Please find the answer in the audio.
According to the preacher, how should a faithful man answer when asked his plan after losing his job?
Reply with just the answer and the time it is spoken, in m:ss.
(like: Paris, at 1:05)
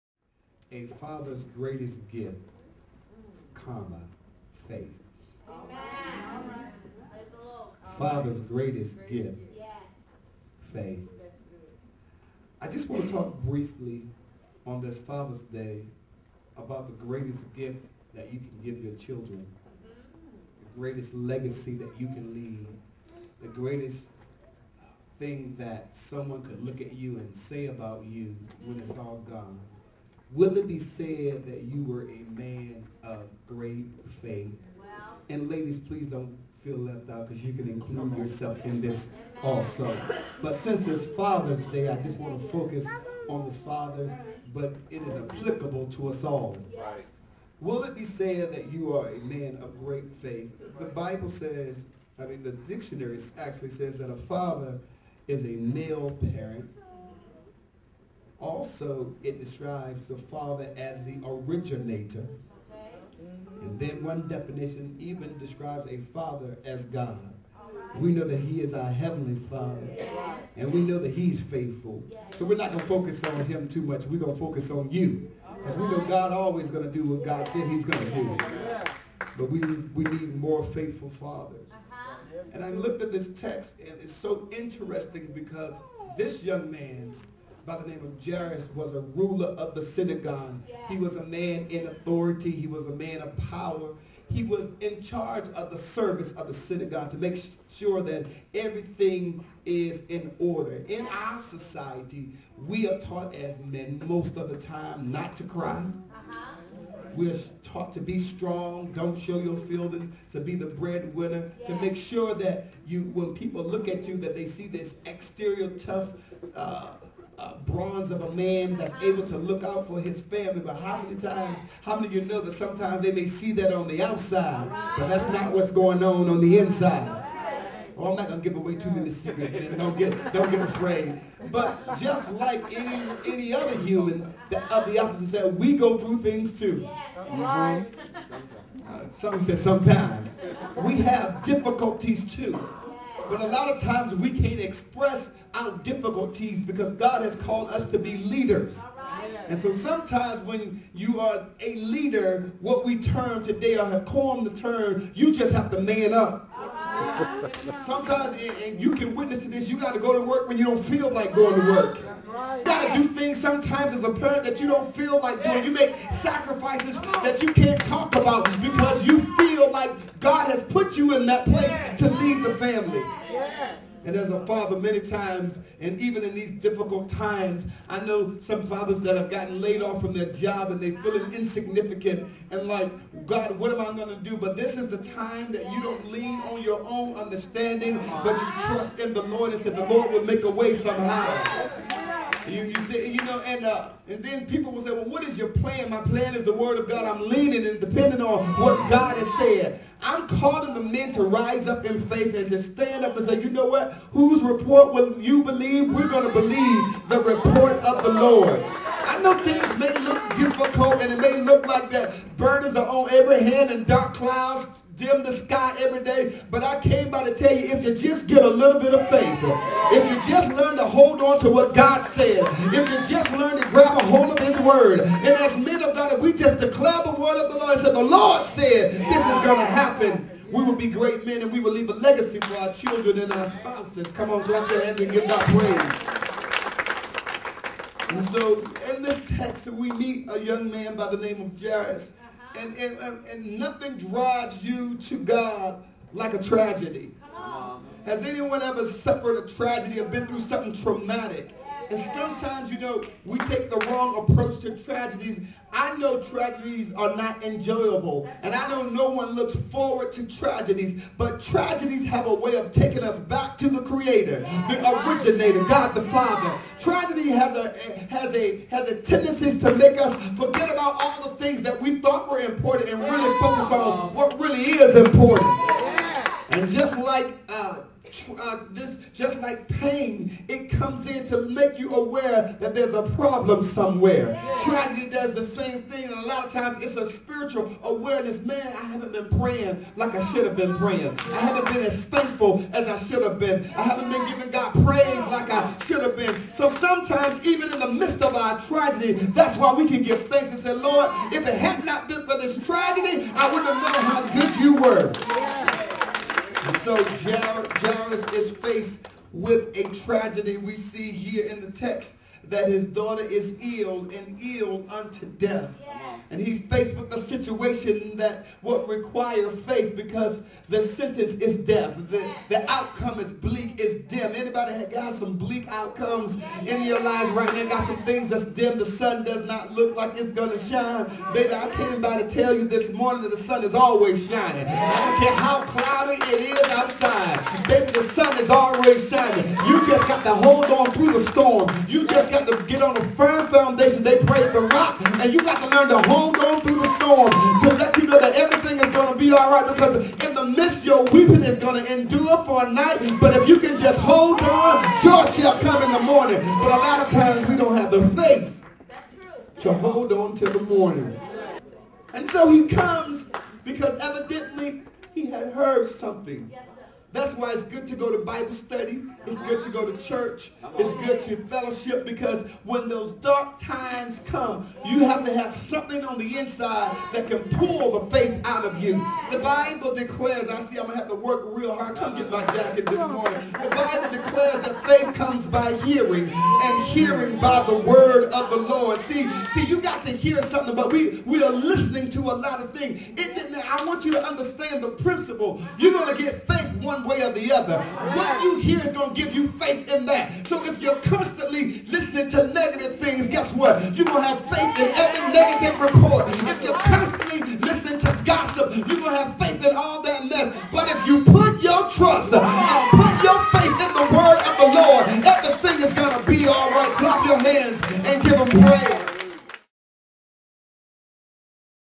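The word of God, at 3:16.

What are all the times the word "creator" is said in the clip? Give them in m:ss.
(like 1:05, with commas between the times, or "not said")
4:23.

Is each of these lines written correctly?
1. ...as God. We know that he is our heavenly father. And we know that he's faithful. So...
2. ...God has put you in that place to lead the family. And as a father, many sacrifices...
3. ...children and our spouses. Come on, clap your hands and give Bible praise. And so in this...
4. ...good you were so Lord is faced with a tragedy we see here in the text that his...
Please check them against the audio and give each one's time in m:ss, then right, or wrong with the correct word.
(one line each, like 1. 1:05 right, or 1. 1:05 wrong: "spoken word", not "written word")
1. 1:06 right
2. 2:50 wrong: "times", not "sacrifices"
3. 3:52 wrong: "God", not "Bible"
4. 5:04 wrong: "Jairus", not "Lord".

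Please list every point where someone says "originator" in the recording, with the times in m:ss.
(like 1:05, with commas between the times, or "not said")
1:01, 4:25.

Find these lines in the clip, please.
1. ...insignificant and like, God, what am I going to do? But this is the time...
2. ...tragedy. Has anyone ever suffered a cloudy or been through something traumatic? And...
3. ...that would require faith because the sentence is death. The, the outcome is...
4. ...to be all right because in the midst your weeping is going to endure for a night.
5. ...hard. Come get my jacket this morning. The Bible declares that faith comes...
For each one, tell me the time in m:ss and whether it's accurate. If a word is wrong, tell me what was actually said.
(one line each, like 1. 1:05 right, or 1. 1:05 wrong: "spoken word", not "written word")
1. 3:01 right
2. 4:06 wrong: "tragedy", not "cloudy"
3. 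5:18 right
4. 5:49 right
5. 6:21 right.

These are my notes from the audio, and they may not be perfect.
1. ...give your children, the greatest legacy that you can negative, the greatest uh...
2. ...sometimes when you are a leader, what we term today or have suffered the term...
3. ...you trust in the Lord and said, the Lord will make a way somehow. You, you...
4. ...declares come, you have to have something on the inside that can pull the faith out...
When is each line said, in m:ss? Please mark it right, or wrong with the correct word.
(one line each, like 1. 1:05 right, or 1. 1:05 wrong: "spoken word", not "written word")
1. 0:18 wrong: "leave", not "negative"
2. 2:29 wrong: "coined", not "suffered"
3. 3:08 right
4. 6:13 wrong: "times", not "declares".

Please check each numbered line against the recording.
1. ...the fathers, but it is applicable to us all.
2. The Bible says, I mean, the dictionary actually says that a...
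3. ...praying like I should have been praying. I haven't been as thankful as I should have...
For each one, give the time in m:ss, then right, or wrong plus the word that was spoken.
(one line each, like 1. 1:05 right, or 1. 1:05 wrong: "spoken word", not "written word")
1. 0:43 right
2. 0:50 right
3. 4:49 right.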